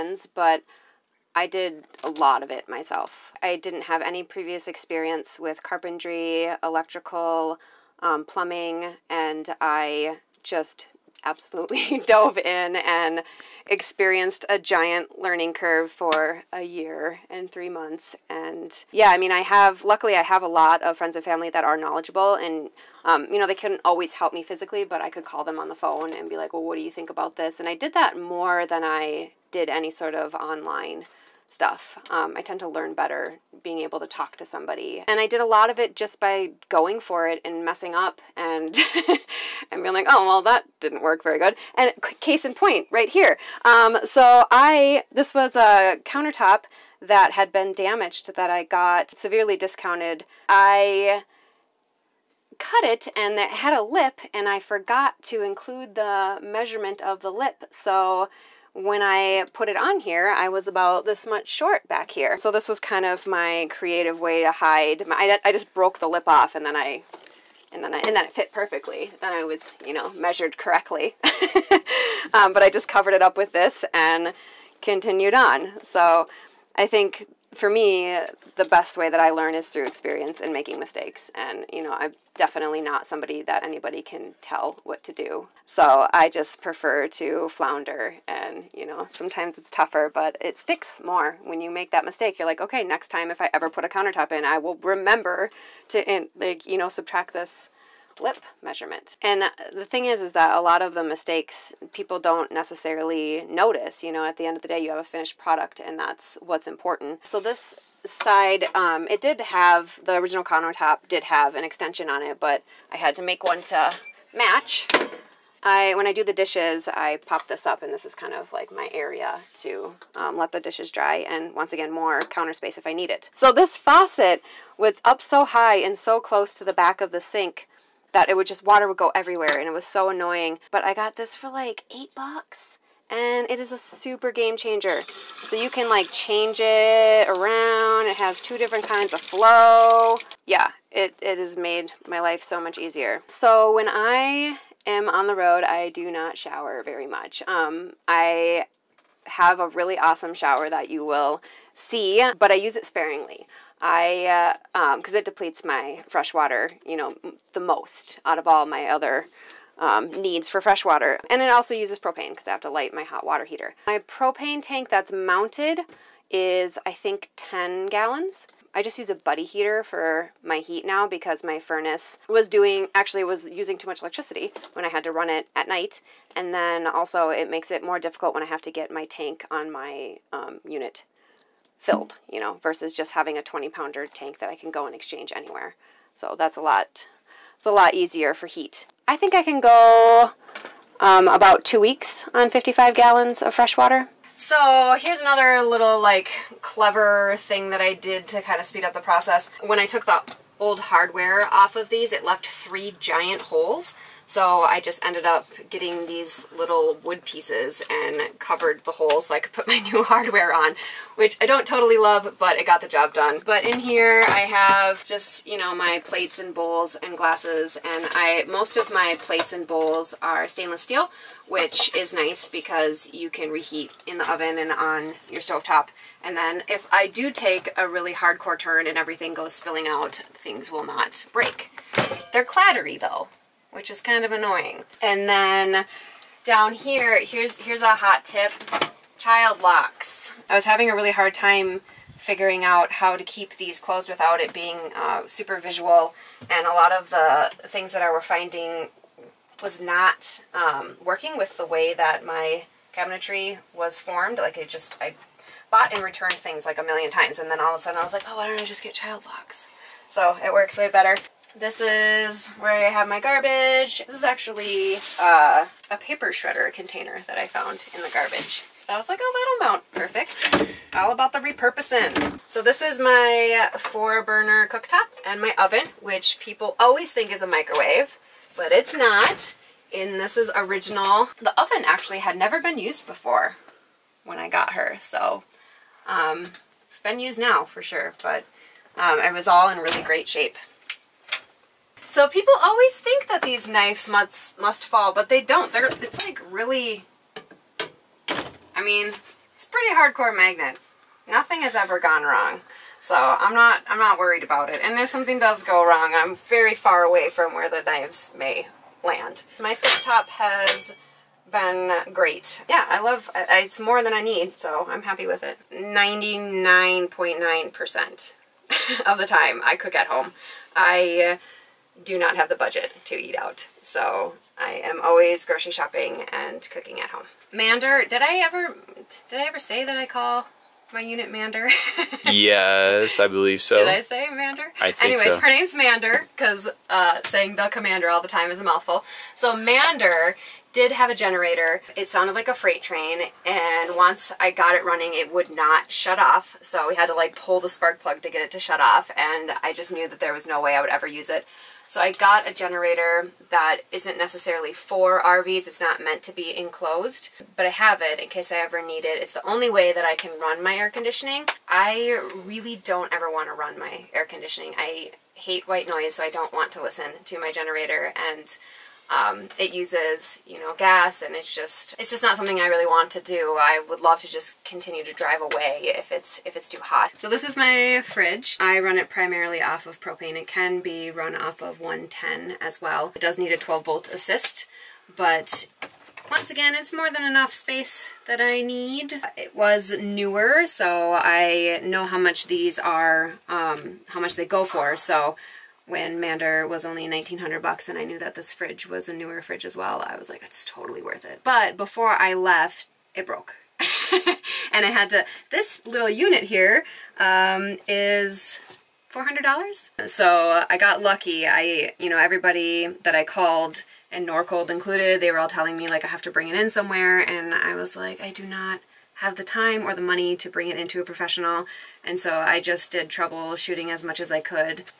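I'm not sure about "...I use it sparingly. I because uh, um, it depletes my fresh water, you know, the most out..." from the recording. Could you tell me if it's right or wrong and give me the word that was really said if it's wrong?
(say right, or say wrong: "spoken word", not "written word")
right.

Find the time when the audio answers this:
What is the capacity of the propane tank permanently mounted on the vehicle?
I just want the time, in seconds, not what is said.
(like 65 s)
167 s.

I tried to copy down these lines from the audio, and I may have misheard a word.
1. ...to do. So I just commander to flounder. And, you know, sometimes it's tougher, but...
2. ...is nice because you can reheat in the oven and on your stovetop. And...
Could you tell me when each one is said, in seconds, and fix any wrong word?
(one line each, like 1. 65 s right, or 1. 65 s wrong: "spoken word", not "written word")
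1. 85 s wrong: "prefer", not "commander"
2. 221 s right.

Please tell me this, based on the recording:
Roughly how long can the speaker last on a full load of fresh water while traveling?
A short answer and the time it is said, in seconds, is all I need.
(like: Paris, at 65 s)
about two weeks, at 191 s.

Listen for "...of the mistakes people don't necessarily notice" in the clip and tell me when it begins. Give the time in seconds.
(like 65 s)
100 s.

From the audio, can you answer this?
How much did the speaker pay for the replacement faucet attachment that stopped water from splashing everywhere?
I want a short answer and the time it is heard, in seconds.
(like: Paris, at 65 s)
$8, at 131 s.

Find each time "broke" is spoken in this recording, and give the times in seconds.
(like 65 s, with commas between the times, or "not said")
65 s, 403 s.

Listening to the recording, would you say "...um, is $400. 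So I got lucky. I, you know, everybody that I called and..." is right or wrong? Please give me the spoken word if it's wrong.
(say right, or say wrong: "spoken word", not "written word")
right.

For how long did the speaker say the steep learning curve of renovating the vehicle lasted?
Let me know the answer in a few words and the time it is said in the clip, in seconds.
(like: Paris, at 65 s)
a year and three months, at 16 s.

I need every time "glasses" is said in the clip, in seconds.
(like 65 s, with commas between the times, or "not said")
217 s.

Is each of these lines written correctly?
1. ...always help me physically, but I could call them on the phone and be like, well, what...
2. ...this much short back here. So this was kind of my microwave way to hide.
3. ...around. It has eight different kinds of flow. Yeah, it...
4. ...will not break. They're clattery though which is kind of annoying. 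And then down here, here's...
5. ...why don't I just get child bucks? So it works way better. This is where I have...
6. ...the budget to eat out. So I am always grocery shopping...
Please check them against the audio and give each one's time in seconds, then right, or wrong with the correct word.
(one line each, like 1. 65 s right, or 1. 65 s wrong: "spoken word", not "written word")
1. 23 s right
2. 61 s wrong: "creative", not "microwave"
3. 137 s wrong: "two", not "eight"
4. 230 s right
5. 258 s wrong: "locks", not "bucks"
6. 322 s right.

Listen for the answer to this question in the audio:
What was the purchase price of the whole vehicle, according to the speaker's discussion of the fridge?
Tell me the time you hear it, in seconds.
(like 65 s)
397 s.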